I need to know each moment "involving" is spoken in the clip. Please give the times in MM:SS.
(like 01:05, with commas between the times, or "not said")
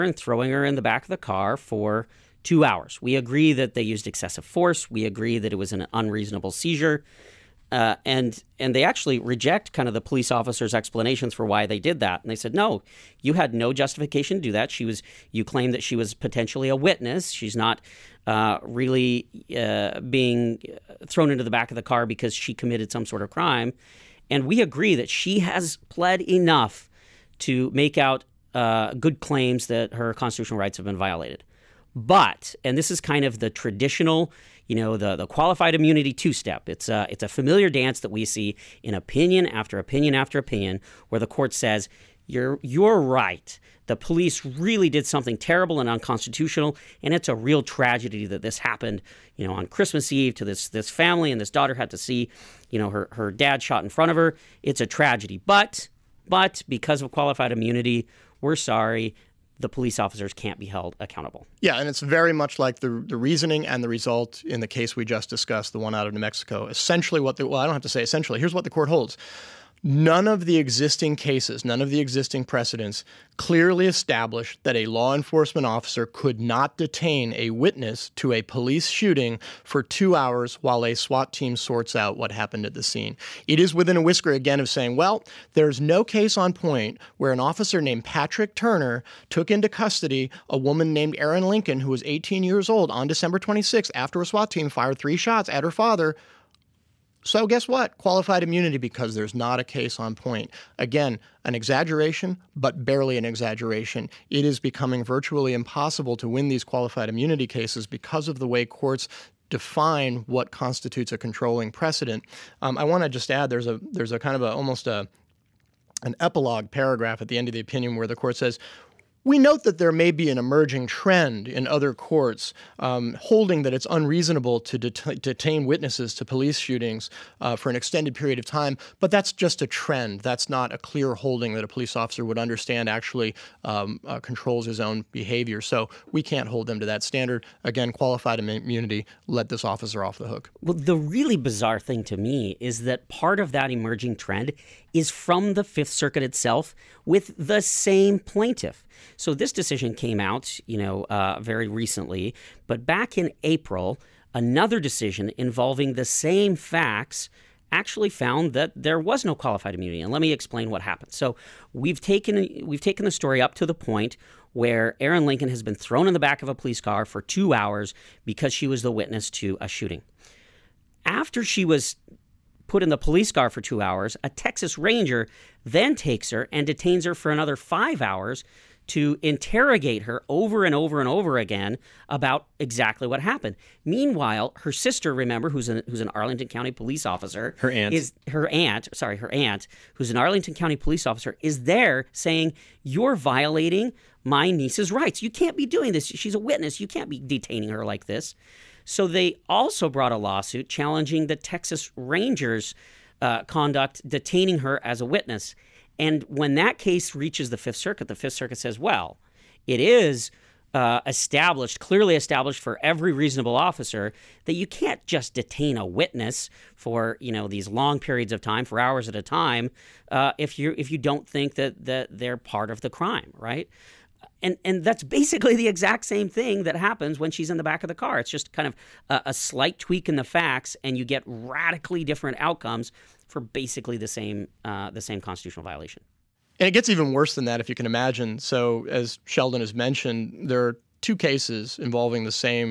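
02:35, 04:01.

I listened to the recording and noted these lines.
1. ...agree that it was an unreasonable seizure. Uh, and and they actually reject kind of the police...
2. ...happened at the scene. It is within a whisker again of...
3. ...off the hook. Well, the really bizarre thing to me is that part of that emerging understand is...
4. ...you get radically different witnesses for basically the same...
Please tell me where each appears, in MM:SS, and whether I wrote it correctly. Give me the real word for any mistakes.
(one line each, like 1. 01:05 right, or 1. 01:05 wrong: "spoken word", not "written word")
1. 00:05 right
2. 01:22 right
3. 02:20 wrong: "trend", not "understand"
4. 03:50 wrong: "outcomes", not "witnesses".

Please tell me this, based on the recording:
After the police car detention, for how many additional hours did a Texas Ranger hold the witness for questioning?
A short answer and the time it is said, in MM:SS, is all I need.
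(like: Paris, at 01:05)
5 hours, at 02:57.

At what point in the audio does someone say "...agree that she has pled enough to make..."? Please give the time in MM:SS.
00:24.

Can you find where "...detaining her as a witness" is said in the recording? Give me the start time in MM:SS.
03:24.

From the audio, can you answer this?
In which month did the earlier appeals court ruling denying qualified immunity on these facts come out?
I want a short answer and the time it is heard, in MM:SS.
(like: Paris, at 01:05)
April, at 02:33.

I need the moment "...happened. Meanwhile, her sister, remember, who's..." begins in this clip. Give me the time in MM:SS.
03:03.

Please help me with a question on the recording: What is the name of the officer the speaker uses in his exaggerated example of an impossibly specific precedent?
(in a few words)
Patrick Turner.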